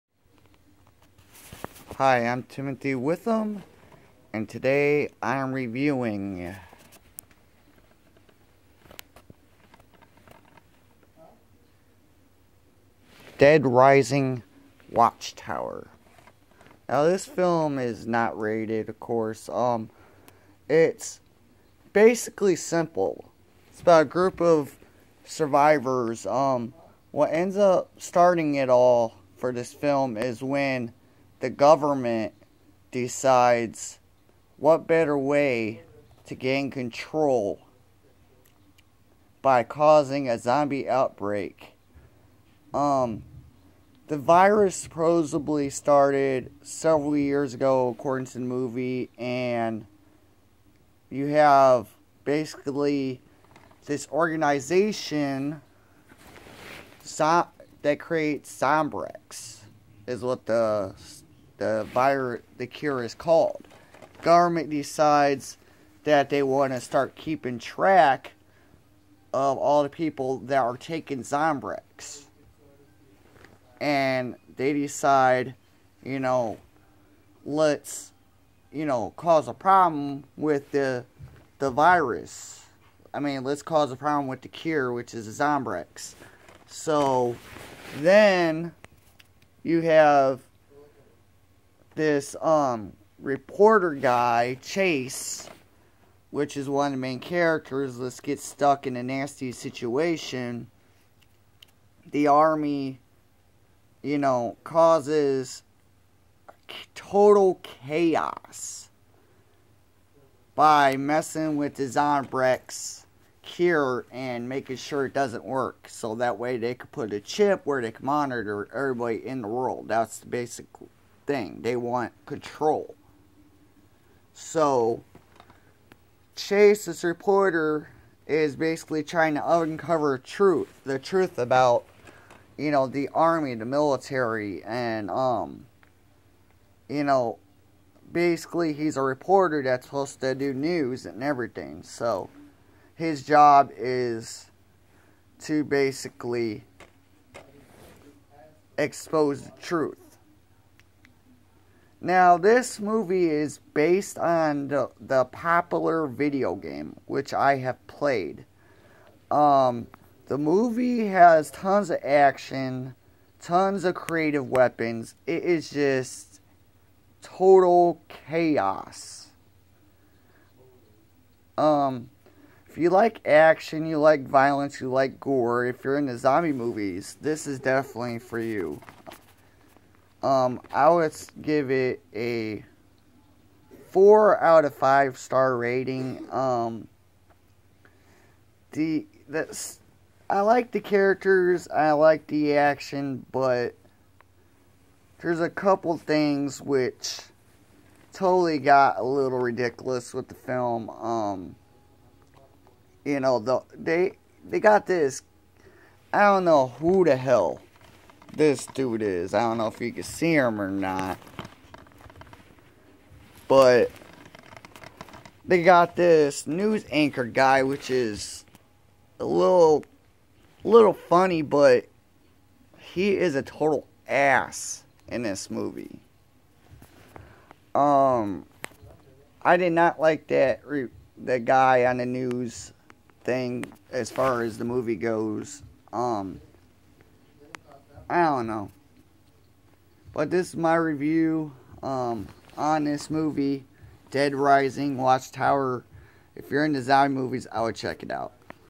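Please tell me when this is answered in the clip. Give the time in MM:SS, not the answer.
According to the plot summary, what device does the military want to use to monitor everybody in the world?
01:57.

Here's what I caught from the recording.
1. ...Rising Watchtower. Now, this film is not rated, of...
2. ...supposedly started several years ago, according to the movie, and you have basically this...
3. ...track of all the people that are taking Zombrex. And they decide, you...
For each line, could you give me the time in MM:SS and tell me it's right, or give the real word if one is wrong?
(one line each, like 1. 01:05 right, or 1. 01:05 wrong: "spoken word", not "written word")
1. 00:13 right
2. 00:44 right
3. 01:07 right.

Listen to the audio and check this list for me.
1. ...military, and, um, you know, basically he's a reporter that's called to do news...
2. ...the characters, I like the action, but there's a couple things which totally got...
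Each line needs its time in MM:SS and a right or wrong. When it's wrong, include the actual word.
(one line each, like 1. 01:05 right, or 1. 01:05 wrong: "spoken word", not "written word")
1. 02:13 wrong: "supposed", not "called"
2. 03:10 right.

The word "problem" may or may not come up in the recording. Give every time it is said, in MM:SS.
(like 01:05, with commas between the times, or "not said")
01:19, 01:23.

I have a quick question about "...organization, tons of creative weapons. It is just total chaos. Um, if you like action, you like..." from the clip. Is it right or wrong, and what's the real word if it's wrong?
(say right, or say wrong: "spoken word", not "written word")
wrong: "action", not "organization".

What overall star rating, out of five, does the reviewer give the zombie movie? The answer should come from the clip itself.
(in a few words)
4.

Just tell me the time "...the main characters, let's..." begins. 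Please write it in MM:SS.
01:36.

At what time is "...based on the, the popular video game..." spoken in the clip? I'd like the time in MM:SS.
02:33.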